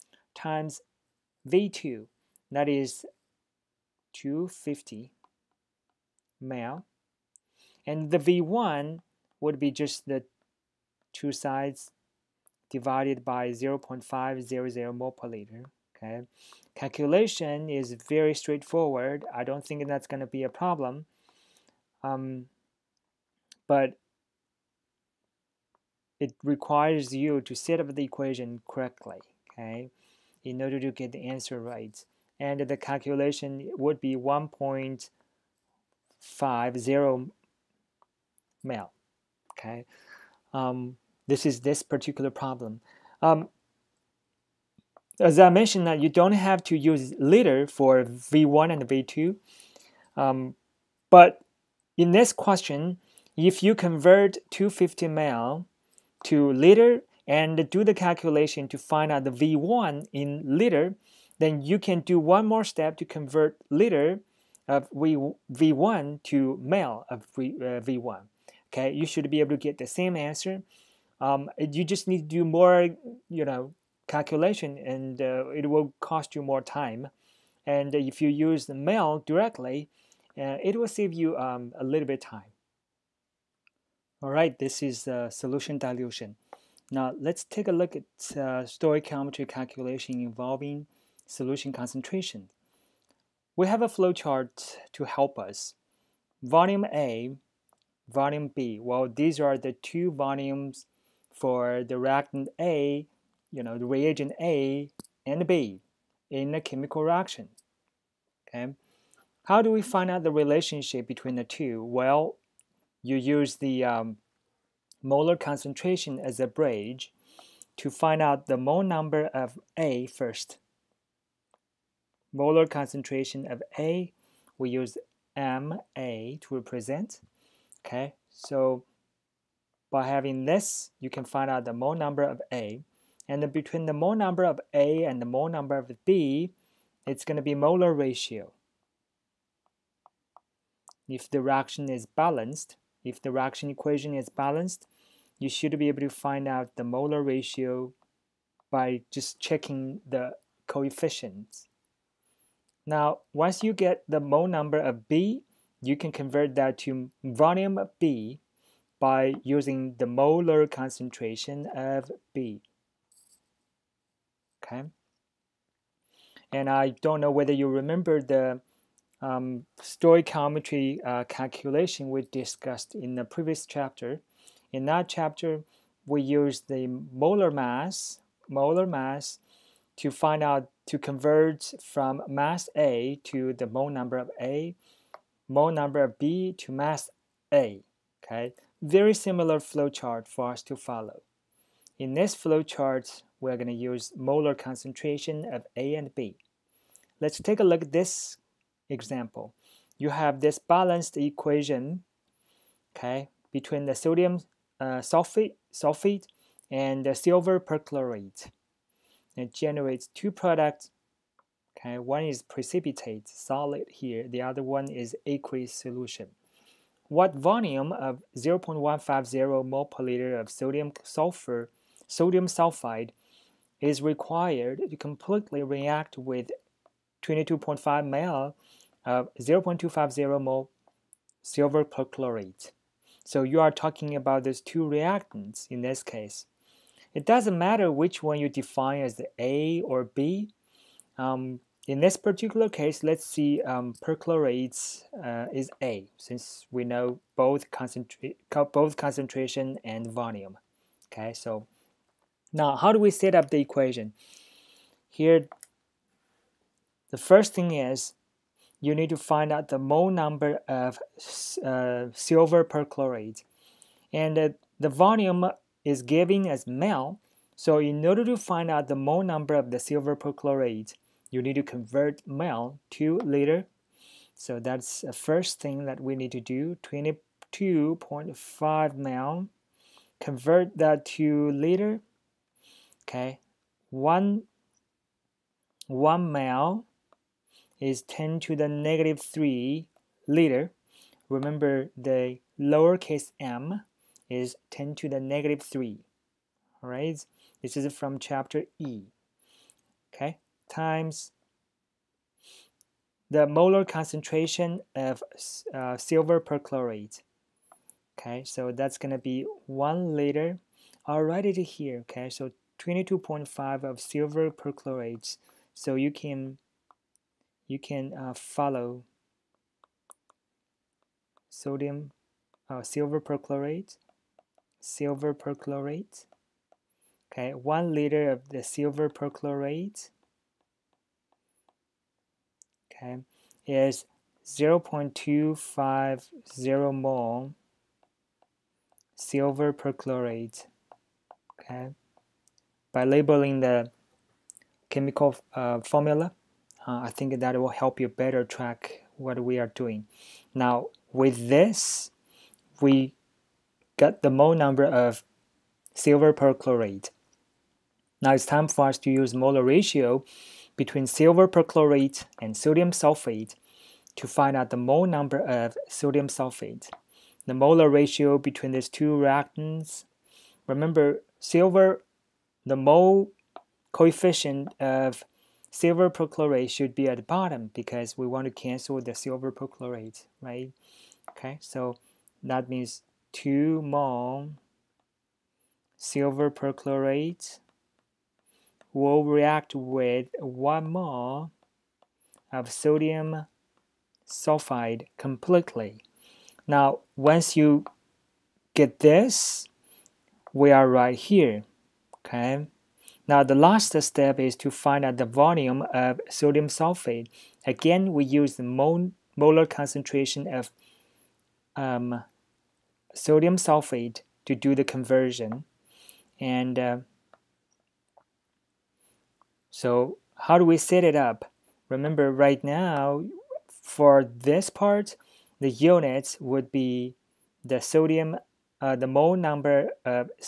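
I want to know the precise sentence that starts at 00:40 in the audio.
Um, this is this particular problem.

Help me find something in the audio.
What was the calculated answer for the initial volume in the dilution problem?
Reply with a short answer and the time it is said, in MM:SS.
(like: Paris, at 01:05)
1.50 mL, at 00:34.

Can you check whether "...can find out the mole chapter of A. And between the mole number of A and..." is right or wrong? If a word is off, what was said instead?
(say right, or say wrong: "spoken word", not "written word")
wrong: "number", not "chapter".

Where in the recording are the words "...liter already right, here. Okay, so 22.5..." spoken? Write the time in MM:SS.
05:10.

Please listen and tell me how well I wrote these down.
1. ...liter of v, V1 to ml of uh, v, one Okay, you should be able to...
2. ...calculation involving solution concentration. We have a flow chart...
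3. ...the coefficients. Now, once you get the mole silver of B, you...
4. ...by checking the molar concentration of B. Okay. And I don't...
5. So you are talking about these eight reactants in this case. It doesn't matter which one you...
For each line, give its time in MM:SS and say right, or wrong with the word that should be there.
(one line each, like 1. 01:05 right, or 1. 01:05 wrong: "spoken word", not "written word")
1. 01:03 right
2. 01:29 right
3. 02:30 wrong: "number", not "silver"
4. 02:38 wrong: "using", not "checking"
5. 03:53 wrong: "two", not "eight".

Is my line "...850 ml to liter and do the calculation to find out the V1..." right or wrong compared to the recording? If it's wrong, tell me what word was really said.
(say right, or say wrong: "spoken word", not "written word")
wrong: "250", not "850".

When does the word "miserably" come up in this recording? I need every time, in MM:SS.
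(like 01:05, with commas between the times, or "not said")
not said.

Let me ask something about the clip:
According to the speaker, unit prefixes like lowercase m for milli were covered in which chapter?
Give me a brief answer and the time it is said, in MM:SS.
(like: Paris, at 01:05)
Chapter E, at 04:58.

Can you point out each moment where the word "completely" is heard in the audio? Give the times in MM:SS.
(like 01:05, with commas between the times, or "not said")
03:44, 06:35.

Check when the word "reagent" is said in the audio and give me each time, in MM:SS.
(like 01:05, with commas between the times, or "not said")
01:43.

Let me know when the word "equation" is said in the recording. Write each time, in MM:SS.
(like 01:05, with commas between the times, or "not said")
00:28, 02:23, 03:21, 04:13.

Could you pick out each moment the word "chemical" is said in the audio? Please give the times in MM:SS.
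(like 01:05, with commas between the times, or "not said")
01:46, 05:44.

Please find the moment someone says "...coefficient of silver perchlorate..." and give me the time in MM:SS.
06:13.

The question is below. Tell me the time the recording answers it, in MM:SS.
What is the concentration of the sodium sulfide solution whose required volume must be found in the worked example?
03:38.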